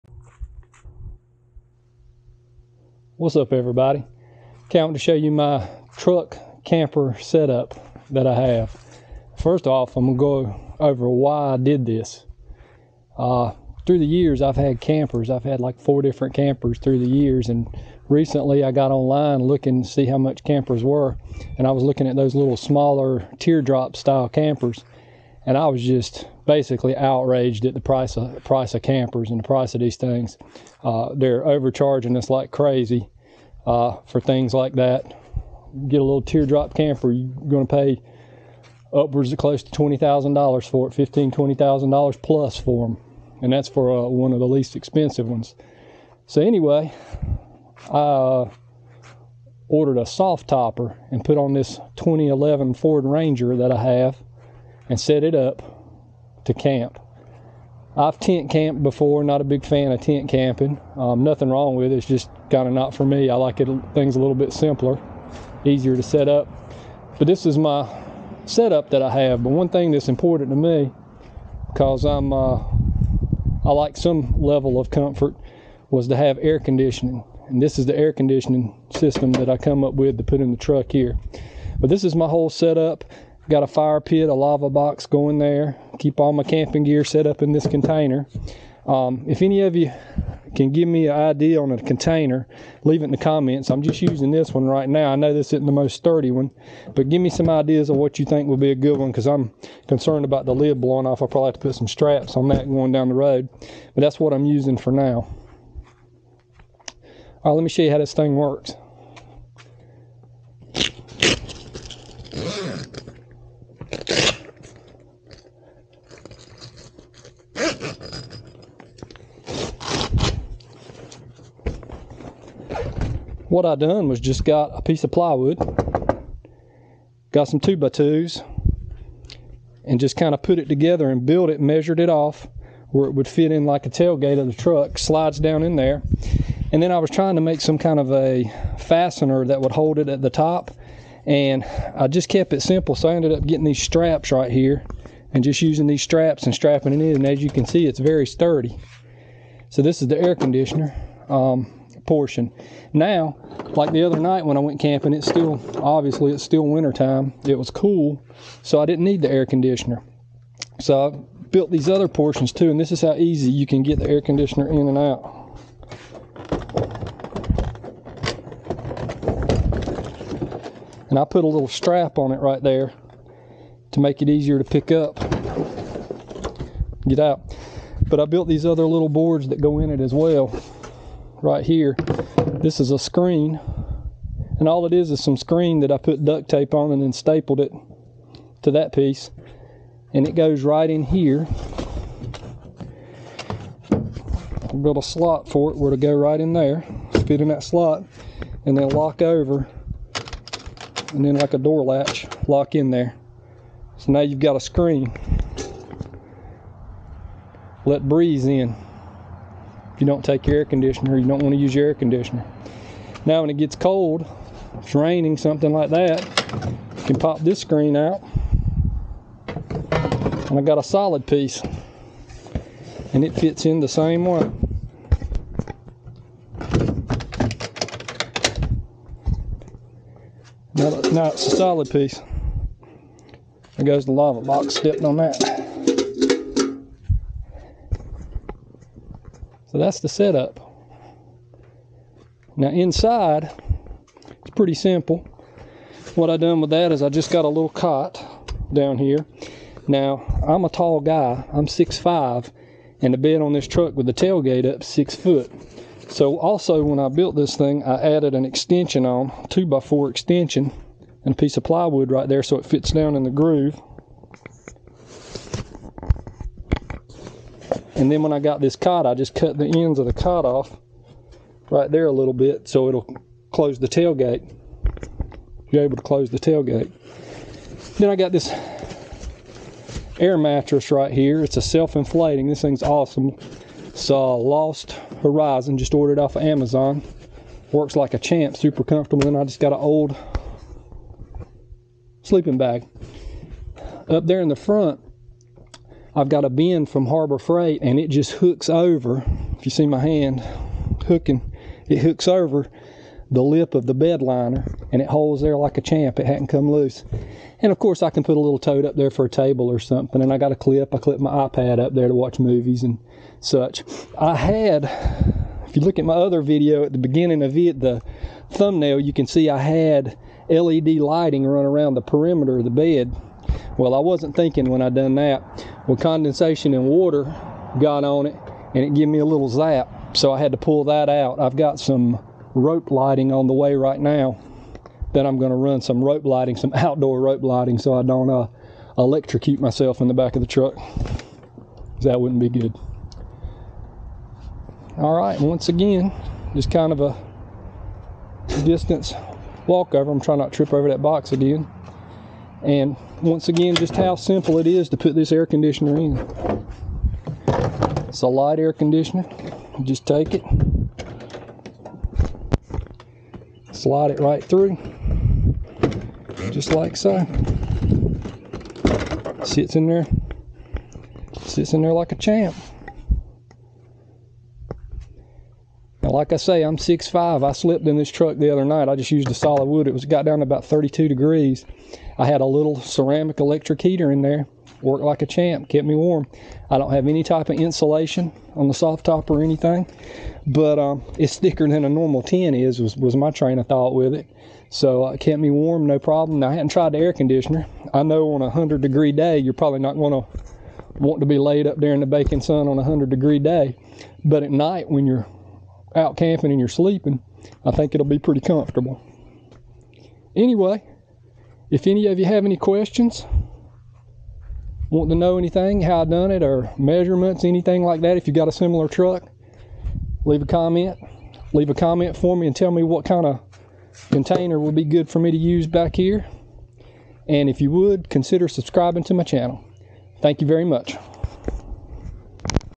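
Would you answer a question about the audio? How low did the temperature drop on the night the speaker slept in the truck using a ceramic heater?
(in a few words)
32 degrees.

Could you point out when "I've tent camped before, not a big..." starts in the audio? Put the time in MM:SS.
00:57.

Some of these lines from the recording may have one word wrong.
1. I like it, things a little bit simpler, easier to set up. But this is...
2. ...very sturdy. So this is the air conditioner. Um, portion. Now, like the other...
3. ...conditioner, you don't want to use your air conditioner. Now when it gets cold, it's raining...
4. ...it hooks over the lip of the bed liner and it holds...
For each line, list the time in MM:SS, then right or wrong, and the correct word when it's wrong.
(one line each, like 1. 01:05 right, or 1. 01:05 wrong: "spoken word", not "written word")
1. 01:03 right
2. 02:27 right
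3. 03:30 right
4. 05:01 right.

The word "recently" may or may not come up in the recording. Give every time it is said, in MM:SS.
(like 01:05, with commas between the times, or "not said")
00:18.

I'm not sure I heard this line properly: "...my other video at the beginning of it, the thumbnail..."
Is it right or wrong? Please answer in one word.
right.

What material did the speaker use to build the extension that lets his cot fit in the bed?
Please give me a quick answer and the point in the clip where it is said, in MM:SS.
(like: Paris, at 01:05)
two by four, at 04:19.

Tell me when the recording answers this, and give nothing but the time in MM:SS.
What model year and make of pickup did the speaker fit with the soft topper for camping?
00:51.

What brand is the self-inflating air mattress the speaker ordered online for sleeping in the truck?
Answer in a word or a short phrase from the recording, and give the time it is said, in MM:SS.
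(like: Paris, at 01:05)
Lost Horizon, at 04:44.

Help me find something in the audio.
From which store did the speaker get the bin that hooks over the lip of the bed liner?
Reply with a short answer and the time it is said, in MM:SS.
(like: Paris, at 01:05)
Harbor Freight, at 04:57.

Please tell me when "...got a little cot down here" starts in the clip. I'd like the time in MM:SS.
04:07.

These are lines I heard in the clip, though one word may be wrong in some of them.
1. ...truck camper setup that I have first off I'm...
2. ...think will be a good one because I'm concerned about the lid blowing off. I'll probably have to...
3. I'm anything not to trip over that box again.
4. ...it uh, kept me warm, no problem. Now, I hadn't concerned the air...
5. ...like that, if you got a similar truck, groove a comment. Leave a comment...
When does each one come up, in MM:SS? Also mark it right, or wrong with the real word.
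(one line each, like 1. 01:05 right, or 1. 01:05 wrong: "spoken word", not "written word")
1. 00:05 right
2. 01:38 right
3. 05:50 wrong: "trying", not "anything"
4. 06:35 wrong: "tried", not "concerned"
5. 06:57 wrong: "leave", not "groove".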